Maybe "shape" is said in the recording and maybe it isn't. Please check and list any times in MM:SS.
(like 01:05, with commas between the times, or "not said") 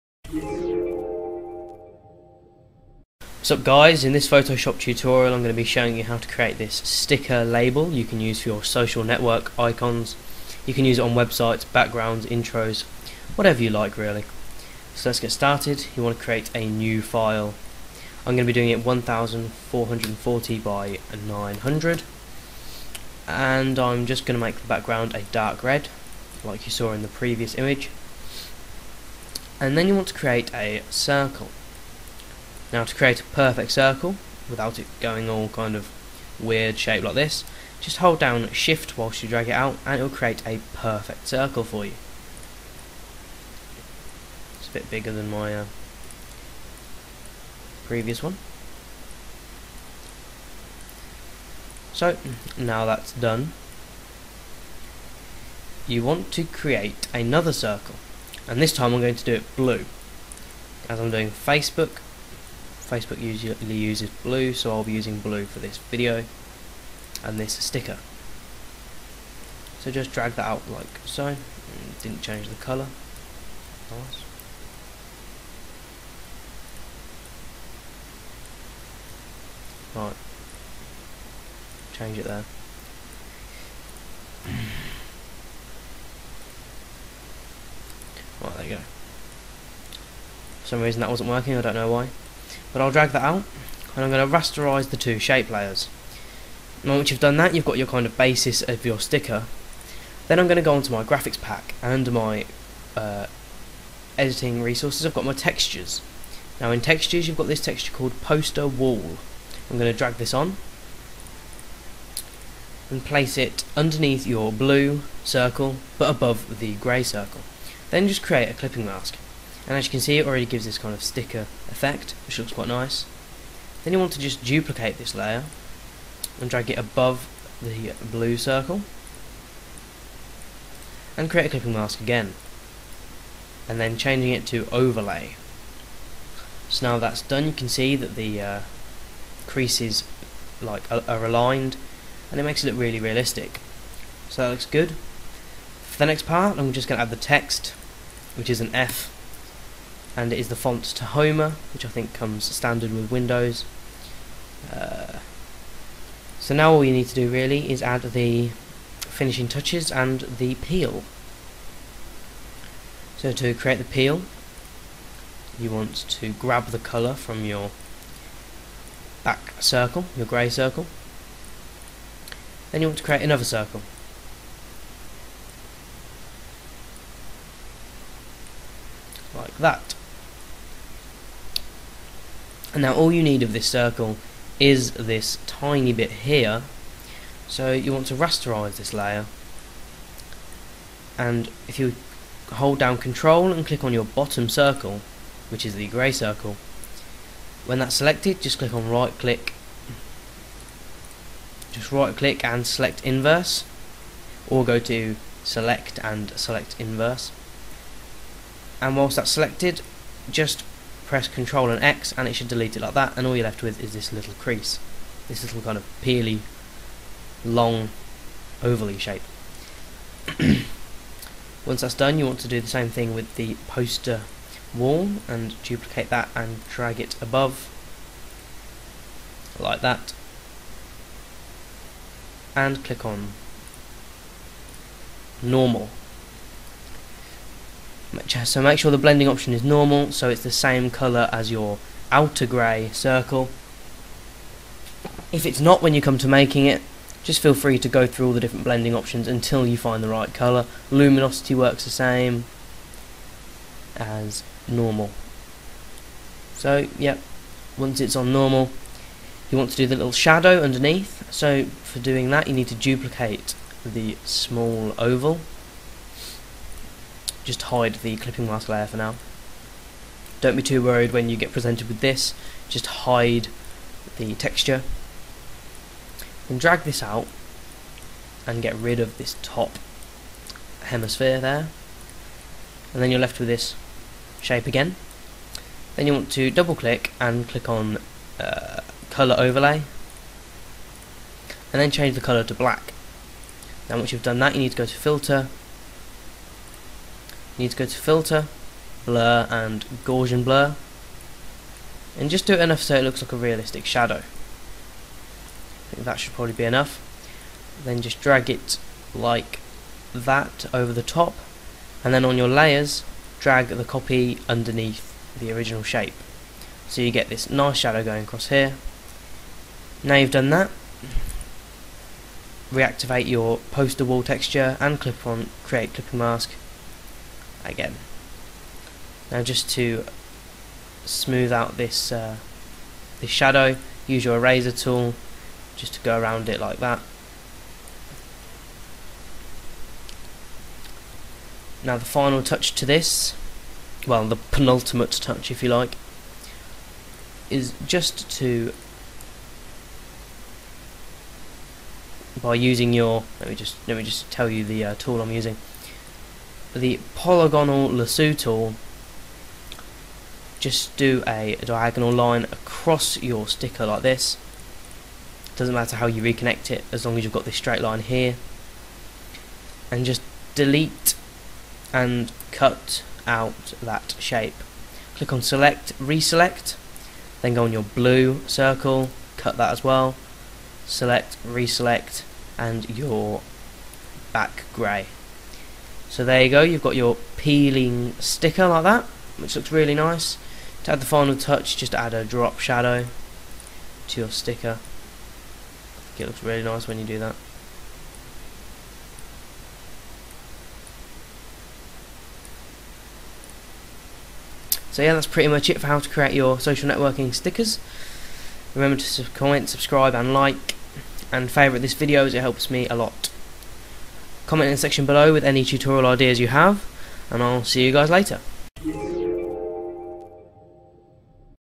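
00:36, 01:35, 03:38, 04:44, 05:15, 06:14.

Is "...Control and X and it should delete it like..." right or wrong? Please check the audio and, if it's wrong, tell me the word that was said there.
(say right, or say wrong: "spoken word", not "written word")
right.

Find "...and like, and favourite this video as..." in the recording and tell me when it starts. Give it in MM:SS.
06:50.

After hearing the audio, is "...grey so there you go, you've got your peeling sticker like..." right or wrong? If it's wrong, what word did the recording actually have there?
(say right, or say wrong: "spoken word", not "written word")
right.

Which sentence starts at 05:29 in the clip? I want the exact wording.
Now just to smooth out this uh, this shadow, use your eraser tool just to go around it like that.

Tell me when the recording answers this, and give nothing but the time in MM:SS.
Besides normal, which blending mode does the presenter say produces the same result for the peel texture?
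04:10.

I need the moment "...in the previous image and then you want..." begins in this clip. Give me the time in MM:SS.
00:26.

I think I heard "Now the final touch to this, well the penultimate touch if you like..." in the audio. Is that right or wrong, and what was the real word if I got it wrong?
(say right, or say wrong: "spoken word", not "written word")
right.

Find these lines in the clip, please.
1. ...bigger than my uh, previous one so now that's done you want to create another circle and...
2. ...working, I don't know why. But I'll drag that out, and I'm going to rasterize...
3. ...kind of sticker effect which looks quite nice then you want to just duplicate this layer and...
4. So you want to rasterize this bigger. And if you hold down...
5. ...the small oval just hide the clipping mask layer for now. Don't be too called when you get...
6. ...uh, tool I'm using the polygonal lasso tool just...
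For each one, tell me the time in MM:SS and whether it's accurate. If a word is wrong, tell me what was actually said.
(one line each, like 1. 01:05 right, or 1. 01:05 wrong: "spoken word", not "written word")
1. 00:44 right
2. 01:31 right
3. 02:00 right
4. 03:07 wrong: "layer", not "bigger"
5. 04:23 wrong: "worried", not "called"
6. 05:54 right.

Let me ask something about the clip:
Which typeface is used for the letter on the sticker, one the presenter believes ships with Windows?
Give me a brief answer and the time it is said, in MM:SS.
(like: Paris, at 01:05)
Tahoma, at 02:30.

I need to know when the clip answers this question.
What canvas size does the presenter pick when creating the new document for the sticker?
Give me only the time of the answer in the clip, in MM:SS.
00:18.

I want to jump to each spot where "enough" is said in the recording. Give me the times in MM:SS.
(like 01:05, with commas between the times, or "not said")
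05:02, 05:06.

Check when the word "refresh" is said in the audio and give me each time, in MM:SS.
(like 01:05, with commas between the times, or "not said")
not said.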